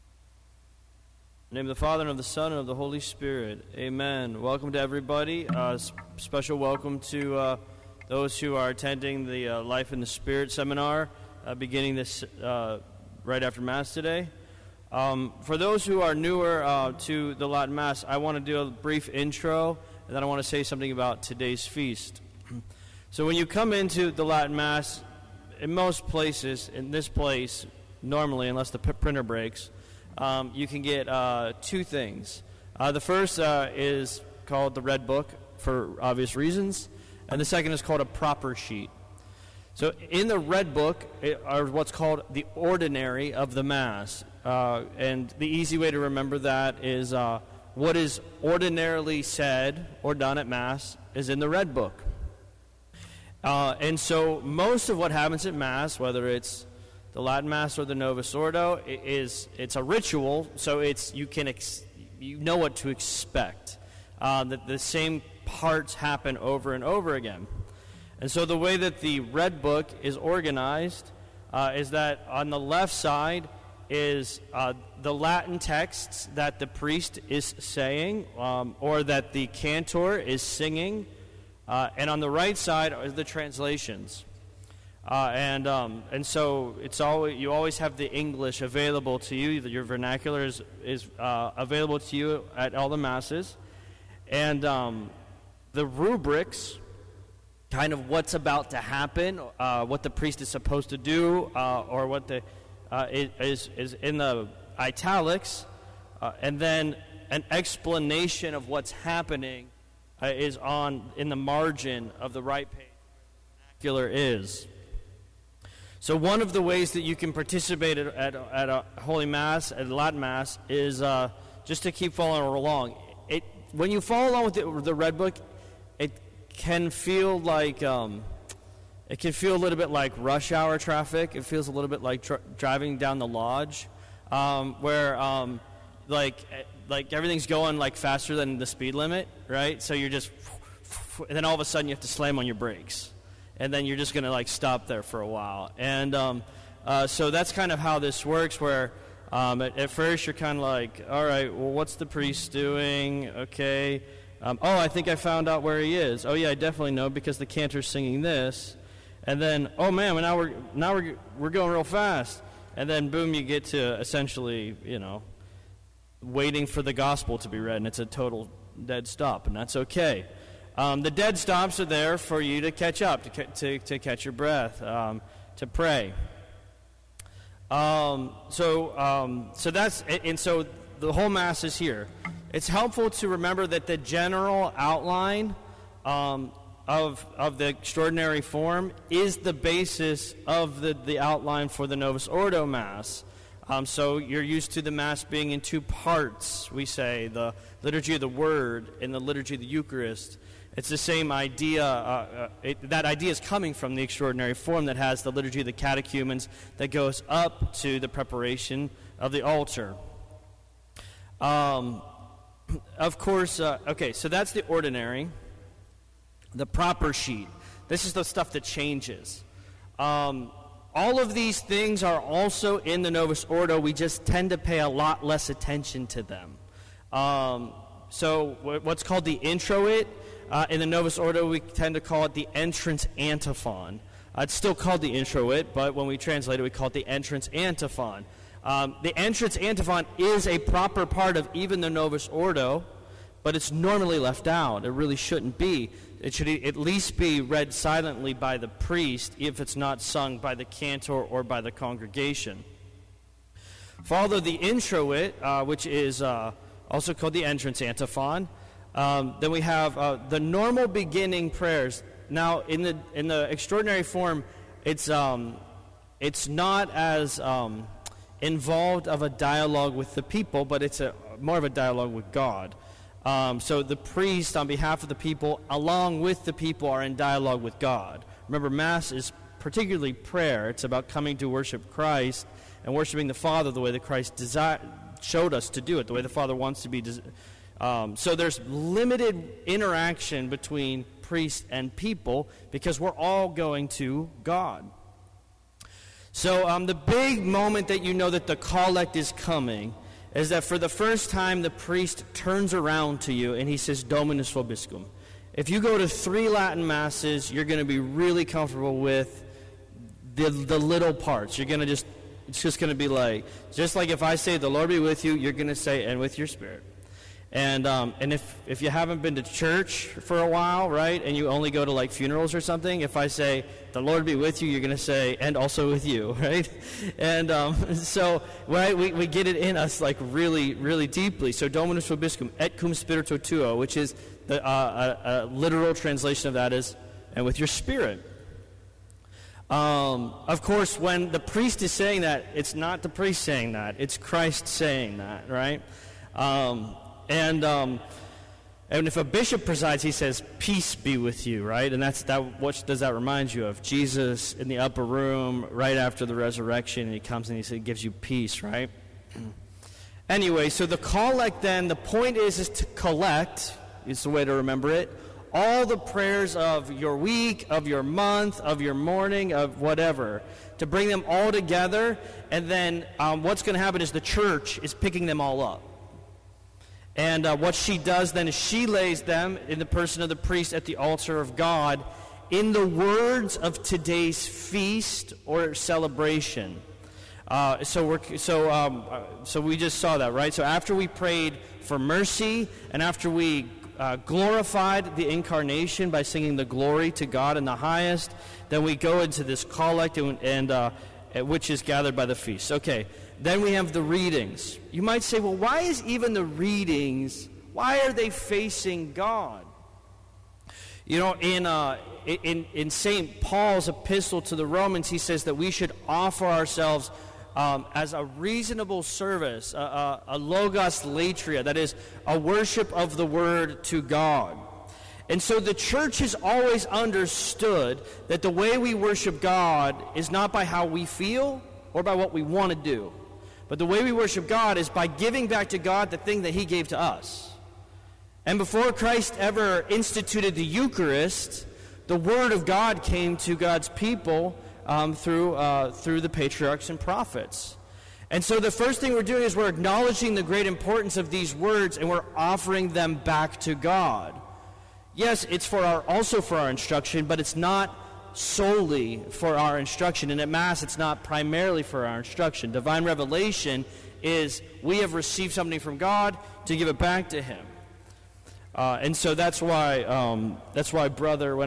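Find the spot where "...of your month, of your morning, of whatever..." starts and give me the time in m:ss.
6:07.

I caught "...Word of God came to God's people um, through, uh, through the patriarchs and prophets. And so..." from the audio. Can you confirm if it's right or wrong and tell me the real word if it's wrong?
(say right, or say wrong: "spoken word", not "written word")
right.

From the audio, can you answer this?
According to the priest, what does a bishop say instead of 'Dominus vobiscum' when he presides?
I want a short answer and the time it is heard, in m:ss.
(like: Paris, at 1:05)
Peace be with you, at 5:50.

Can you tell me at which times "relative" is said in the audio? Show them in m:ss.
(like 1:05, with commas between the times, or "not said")
not said.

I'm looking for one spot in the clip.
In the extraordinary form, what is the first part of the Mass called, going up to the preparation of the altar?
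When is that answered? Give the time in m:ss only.
3:25.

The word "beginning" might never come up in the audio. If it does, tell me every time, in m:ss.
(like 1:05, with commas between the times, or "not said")
0:11, 4:20.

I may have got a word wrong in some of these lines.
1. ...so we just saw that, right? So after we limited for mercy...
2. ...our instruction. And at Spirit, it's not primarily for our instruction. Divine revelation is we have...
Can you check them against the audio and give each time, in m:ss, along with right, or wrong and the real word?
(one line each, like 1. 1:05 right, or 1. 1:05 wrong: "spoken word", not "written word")
1. 6:29 wrong: "prayed", not "limited"
2. 7:39 wrong: "Mass", not "Spirit".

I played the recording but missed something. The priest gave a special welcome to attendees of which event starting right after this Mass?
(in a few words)
Life in the Spirit seminar.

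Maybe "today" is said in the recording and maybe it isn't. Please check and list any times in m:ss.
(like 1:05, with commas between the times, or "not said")
0:13, 0:21, 6:23.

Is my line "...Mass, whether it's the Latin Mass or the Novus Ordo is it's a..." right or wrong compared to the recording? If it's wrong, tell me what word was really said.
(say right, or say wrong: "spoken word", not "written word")
right.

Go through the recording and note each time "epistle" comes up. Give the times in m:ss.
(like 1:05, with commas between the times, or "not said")
6:53.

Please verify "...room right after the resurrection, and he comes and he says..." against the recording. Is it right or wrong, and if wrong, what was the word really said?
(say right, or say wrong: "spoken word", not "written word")
right.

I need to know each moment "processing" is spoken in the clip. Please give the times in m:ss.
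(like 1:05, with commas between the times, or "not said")
not said.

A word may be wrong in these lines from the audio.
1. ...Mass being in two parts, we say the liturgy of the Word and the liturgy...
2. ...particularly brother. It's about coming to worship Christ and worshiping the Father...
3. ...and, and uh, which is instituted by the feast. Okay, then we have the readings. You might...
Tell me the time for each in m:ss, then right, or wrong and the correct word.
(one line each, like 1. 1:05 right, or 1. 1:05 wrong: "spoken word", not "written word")
1. 3:14 right
2. 4:39 wrong: "prayer", not "brother"
3. 6:40 wrong: "gathered", not "instituted".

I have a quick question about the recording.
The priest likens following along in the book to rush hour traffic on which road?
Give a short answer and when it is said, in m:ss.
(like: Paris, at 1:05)
the Lodge, at 2:13.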